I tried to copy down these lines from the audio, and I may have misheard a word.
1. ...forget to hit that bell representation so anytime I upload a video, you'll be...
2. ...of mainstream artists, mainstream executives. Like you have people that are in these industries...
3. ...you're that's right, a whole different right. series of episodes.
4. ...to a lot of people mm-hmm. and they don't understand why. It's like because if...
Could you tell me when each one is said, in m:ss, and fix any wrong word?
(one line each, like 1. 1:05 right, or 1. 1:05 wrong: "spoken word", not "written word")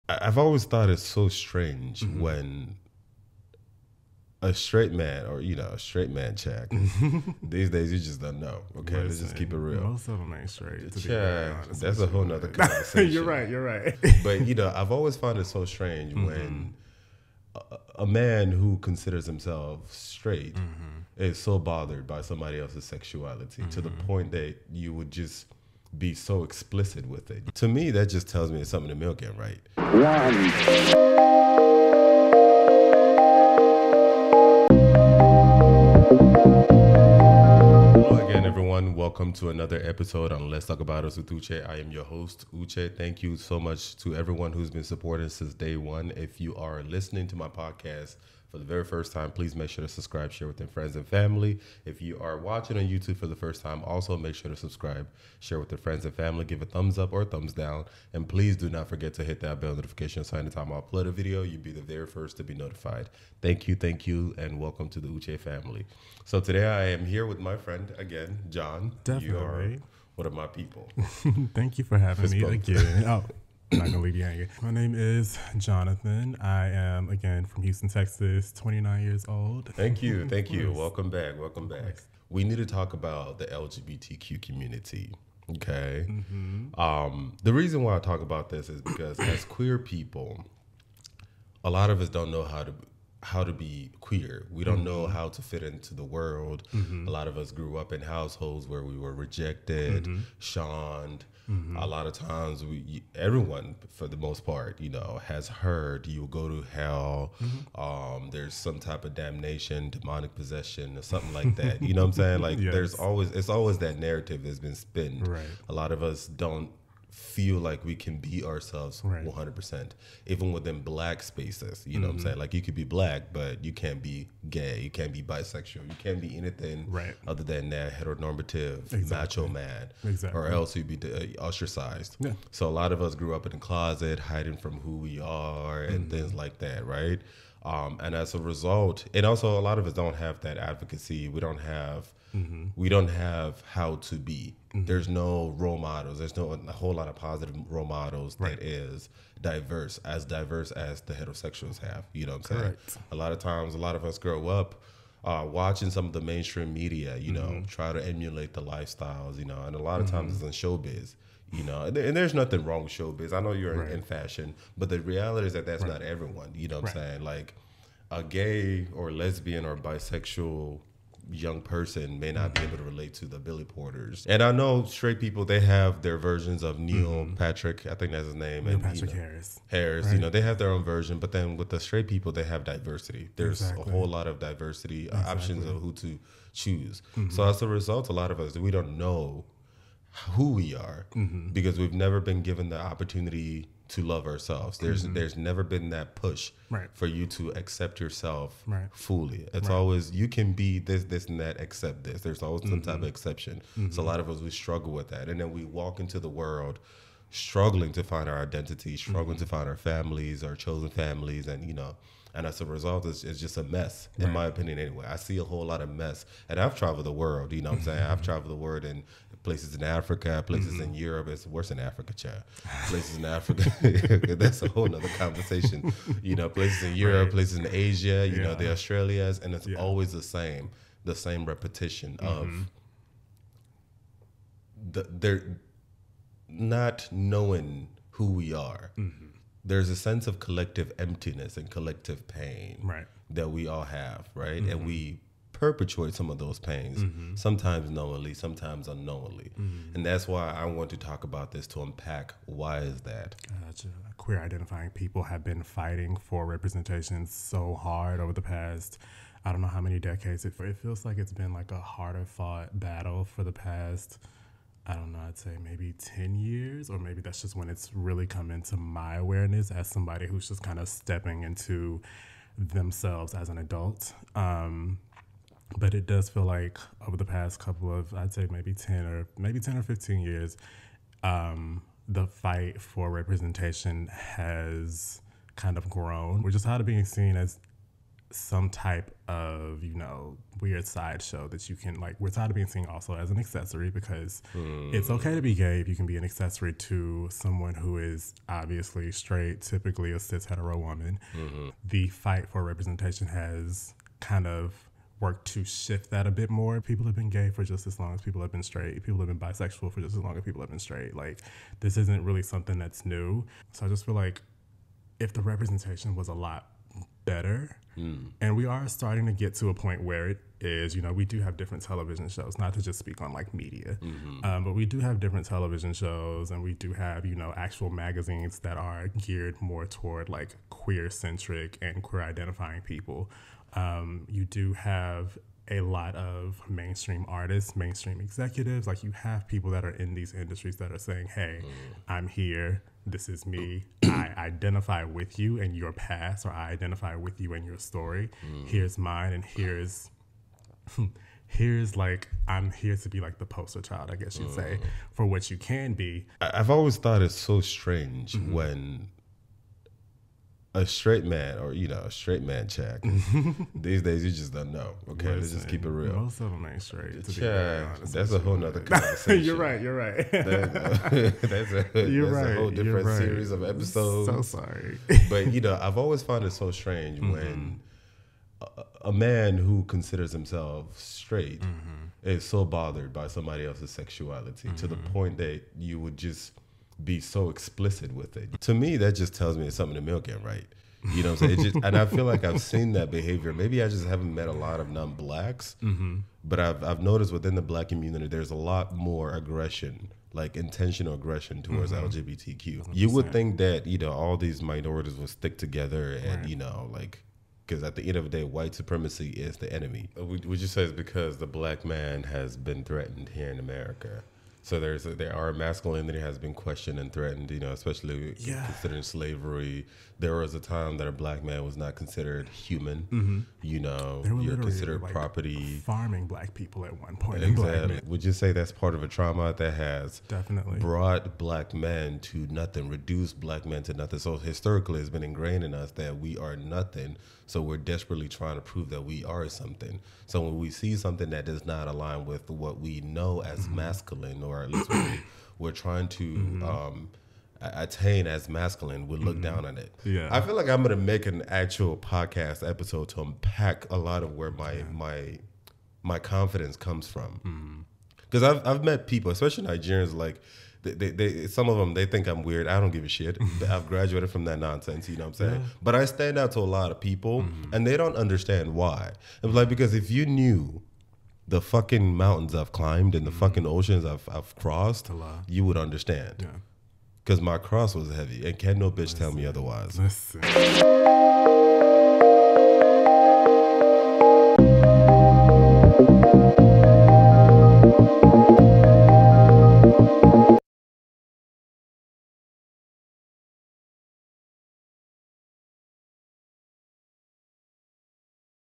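1. 0:58 wrong: "notification", not "representation"
2. 5:36 right
3. 6:12 right
4. 7:46 right.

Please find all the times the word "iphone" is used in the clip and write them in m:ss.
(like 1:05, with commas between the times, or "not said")
not said.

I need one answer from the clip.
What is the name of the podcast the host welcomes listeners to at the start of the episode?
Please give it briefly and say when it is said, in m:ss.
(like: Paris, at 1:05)
Let's Talk About Us with Uche, at 0:40.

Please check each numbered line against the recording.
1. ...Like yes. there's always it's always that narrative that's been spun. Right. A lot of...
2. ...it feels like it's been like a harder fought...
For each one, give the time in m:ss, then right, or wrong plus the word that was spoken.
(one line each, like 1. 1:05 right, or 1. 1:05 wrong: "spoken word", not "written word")
1. 1:52 right
2. 4:20 right.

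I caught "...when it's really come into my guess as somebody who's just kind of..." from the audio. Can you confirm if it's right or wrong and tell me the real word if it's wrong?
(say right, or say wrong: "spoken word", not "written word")
wrong: "awareness", not "guess".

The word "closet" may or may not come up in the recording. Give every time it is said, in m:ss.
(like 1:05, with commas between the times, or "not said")
2:13.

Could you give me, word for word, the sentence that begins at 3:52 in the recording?
of the, they're not knowing who we are.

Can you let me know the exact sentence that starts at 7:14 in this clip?
So historically, it's been ingrained in us that we are nothing.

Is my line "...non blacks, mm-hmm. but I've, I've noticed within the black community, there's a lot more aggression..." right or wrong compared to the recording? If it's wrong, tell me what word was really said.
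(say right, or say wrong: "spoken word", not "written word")
right.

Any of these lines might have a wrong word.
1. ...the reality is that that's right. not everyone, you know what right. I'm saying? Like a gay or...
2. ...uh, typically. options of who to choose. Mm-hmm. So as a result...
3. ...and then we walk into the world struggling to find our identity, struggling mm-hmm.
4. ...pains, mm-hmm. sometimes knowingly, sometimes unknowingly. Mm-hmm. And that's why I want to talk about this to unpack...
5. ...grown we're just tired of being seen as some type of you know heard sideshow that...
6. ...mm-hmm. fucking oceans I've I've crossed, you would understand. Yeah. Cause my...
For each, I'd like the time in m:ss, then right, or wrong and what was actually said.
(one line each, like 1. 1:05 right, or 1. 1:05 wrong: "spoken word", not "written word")
1. 2:44 right
2. 3:05 wrong: "exactly", not "typically"
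3. 3:25 right
4. 4:06 right
5. 4:45 wrong: "weird", not "heard"
6. 7:53 right.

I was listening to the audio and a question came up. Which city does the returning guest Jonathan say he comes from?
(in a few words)
Houston.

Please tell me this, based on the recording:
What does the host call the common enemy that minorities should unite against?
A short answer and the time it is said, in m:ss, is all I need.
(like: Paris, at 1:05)
white supremacy, at 6:48.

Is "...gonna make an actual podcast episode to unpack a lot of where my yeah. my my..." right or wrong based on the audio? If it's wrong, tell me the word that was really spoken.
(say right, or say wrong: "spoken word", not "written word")
right.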